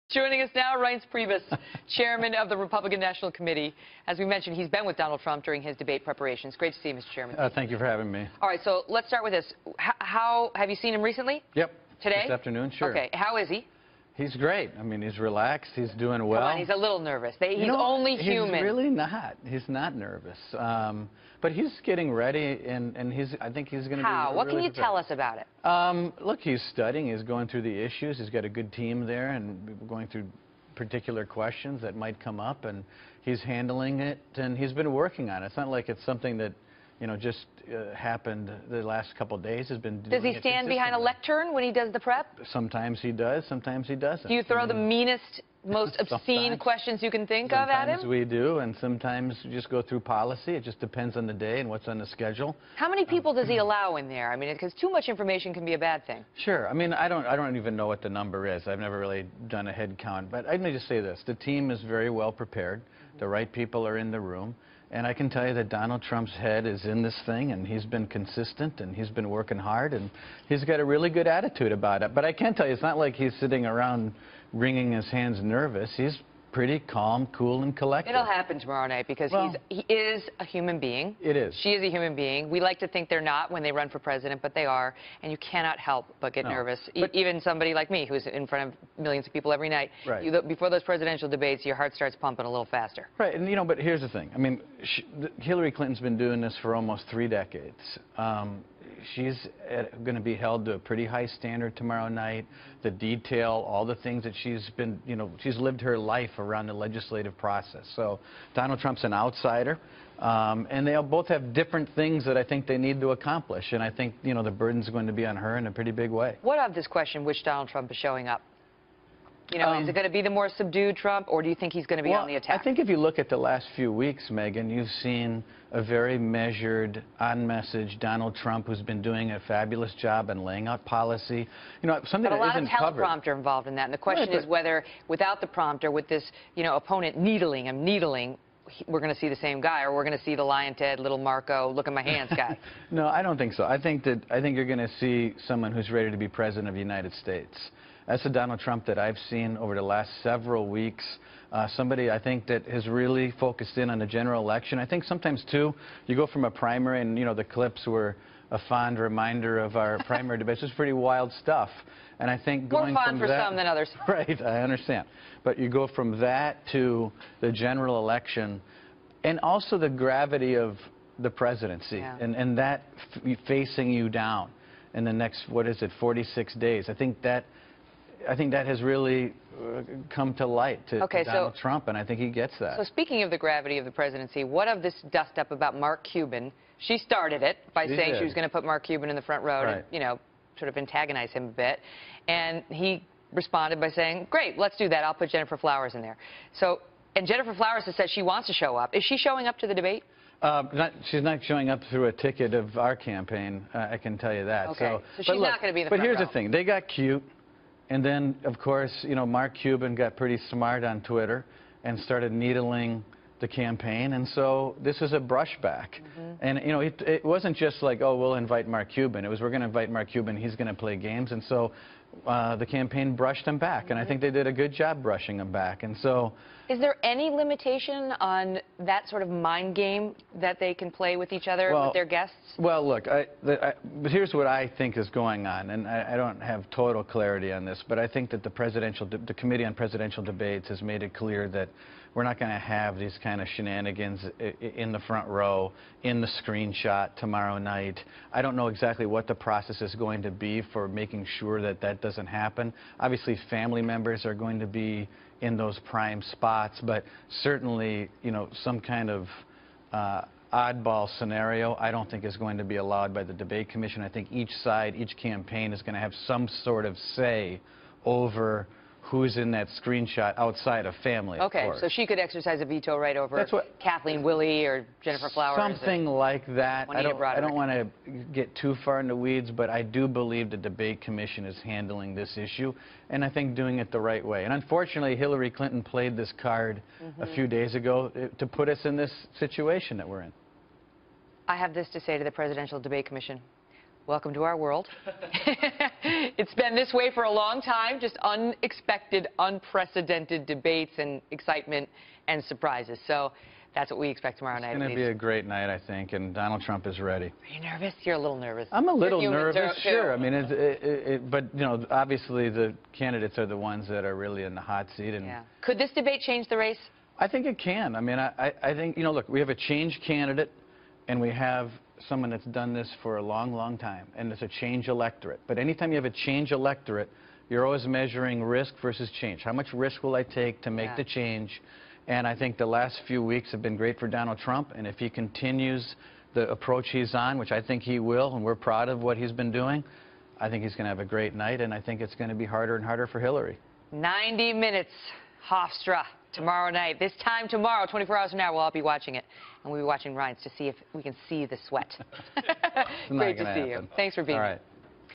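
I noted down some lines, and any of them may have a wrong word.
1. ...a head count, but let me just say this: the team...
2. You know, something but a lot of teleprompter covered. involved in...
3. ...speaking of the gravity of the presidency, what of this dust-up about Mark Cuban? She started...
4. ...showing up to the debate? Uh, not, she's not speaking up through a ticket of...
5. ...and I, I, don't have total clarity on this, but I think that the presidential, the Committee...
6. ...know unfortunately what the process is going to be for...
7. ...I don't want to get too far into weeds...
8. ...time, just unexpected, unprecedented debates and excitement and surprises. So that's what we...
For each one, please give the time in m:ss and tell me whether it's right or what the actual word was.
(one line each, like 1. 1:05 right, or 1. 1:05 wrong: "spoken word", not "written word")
1. 0:59 right
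2. 2:11 right
3. 3:02 right
4. 3:19 wrong: "showing", not "speaking"
5. 3:55 right
6. 4:08 wrong: "exactly", not "unfortunately"
7. 4:37 right
8. 4:57 right.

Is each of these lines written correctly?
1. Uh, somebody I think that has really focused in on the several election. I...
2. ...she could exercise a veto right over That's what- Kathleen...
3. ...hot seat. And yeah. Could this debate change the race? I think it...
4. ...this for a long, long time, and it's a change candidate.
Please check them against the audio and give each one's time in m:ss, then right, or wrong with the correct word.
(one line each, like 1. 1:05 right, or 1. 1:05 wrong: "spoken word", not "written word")
1. 2:31 wrong: "general", not "several"
2. 4:31 right
3. 5:14 right
4. 5:22 wrong: "electorate", not "candidate".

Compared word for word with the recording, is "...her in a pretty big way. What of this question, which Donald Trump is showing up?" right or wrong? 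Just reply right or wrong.
right.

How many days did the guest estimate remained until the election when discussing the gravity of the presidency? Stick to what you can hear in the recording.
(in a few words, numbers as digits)
46.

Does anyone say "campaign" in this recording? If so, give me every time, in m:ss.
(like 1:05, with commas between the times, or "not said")
3:22, 3:33, 3:42, 4:25.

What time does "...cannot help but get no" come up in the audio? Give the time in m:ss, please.
1:25.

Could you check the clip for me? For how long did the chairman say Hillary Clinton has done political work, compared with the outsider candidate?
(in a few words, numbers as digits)
almost three decades.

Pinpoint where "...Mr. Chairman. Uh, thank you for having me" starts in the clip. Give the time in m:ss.
0:06.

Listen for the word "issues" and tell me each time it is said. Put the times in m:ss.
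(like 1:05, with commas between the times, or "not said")
0:27, 4:42.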